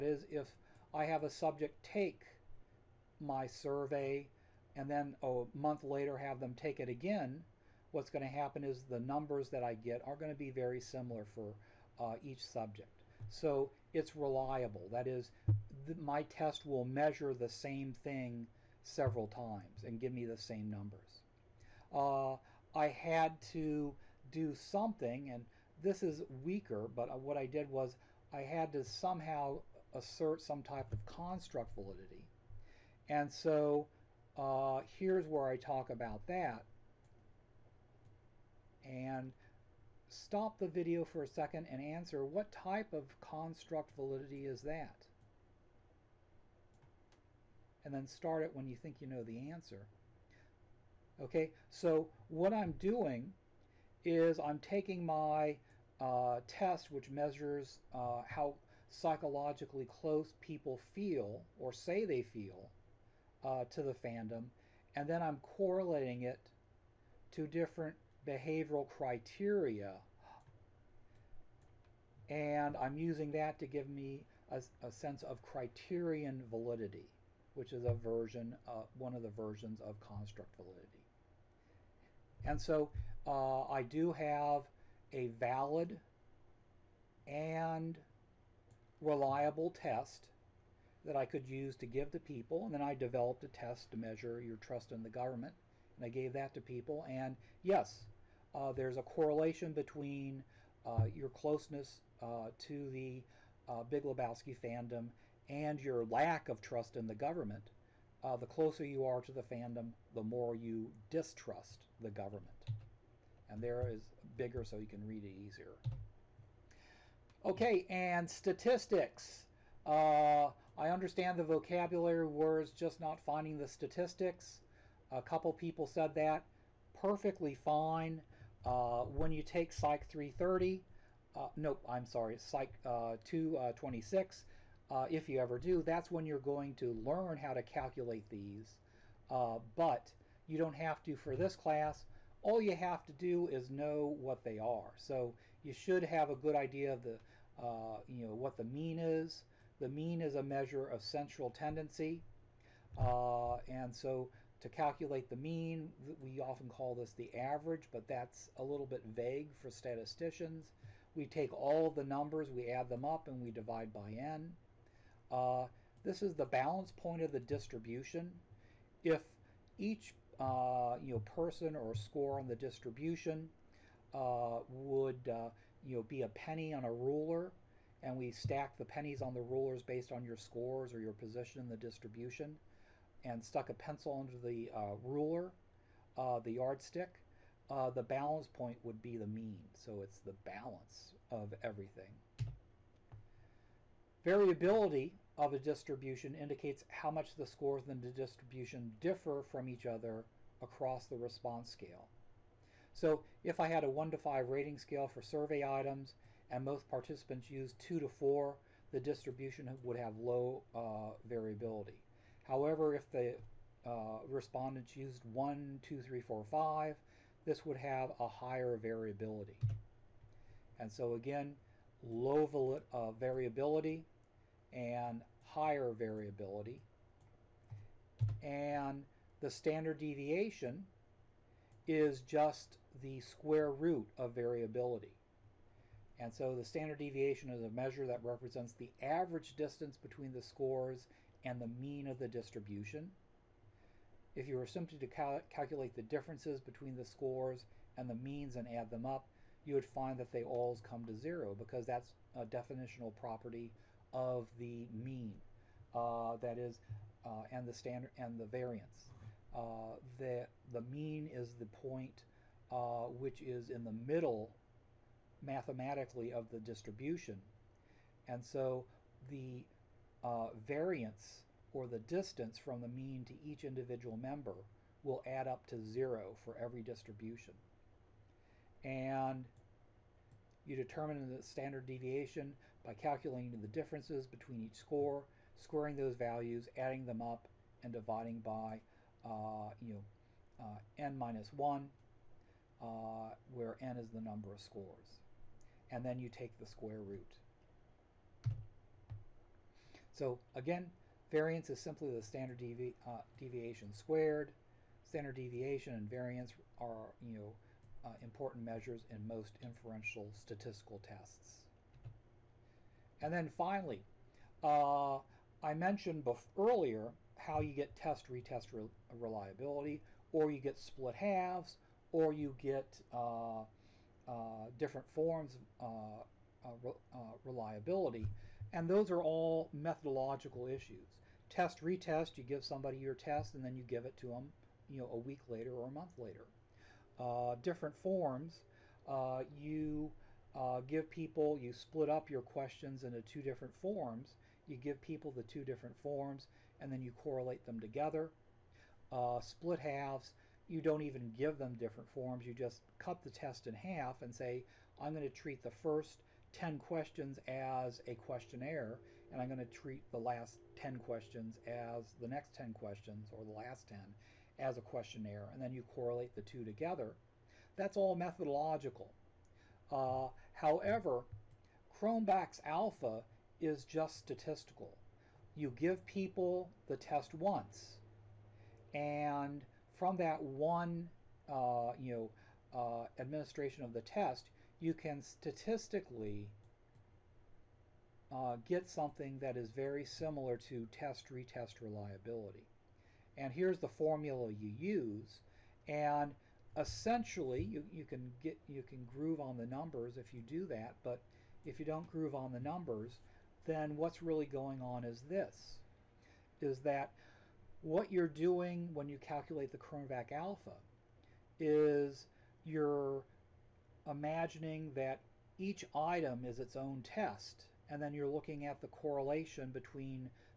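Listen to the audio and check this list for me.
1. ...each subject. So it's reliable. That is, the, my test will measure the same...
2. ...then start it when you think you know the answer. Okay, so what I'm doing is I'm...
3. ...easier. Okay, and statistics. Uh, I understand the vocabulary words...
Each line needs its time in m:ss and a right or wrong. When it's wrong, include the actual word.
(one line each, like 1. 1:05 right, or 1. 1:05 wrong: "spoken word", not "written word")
1. 0:12 right
2. 0:47 right
3. 1:55 right.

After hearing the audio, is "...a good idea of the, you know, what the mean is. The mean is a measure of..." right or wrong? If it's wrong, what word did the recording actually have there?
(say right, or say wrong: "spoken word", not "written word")
right.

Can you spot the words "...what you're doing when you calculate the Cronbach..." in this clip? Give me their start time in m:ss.
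6:47.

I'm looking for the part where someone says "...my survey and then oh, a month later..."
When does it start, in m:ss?
0:03.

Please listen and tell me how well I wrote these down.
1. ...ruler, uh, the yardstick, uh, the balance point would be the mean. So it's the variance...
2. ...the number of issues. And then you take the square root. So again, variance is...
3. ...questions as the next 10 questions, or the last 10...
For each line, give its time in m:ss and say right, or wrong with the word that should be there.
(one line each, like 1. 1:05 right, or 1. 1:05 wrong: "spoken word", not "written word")
1. 3:04 wrong: "balance", not "variance"
2. 4:54 wrong: "scores", not "issues"
3. 6:00 right.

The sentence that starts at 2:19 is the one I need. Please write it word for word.
but you don't have to for this class.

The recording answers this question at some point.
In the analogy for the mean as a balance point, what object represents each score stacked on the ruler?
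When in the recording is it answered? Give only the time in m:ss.
2:56.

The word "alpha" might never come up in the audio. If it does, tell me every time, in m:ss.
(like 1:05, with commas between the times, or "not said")
6:12, 6:50.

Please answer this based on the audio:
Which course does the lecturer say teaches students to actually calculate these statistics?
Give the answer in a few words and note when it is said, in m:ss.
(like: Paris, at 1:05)
Psych 226, at 2:12.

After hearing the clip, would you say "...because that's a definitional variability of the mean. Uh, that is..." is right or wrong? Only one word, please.
wrong.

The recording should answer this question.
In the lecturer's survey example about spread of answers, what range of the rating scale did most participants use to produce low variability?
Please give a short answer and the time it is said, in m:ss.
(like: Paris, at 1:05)
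2 to 4, at 3:27.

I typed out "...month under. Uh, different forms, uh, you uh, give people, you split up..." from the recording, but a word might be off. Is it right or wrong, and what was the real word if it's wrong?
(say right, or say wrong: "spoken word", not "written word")
wrong: "later", not "under".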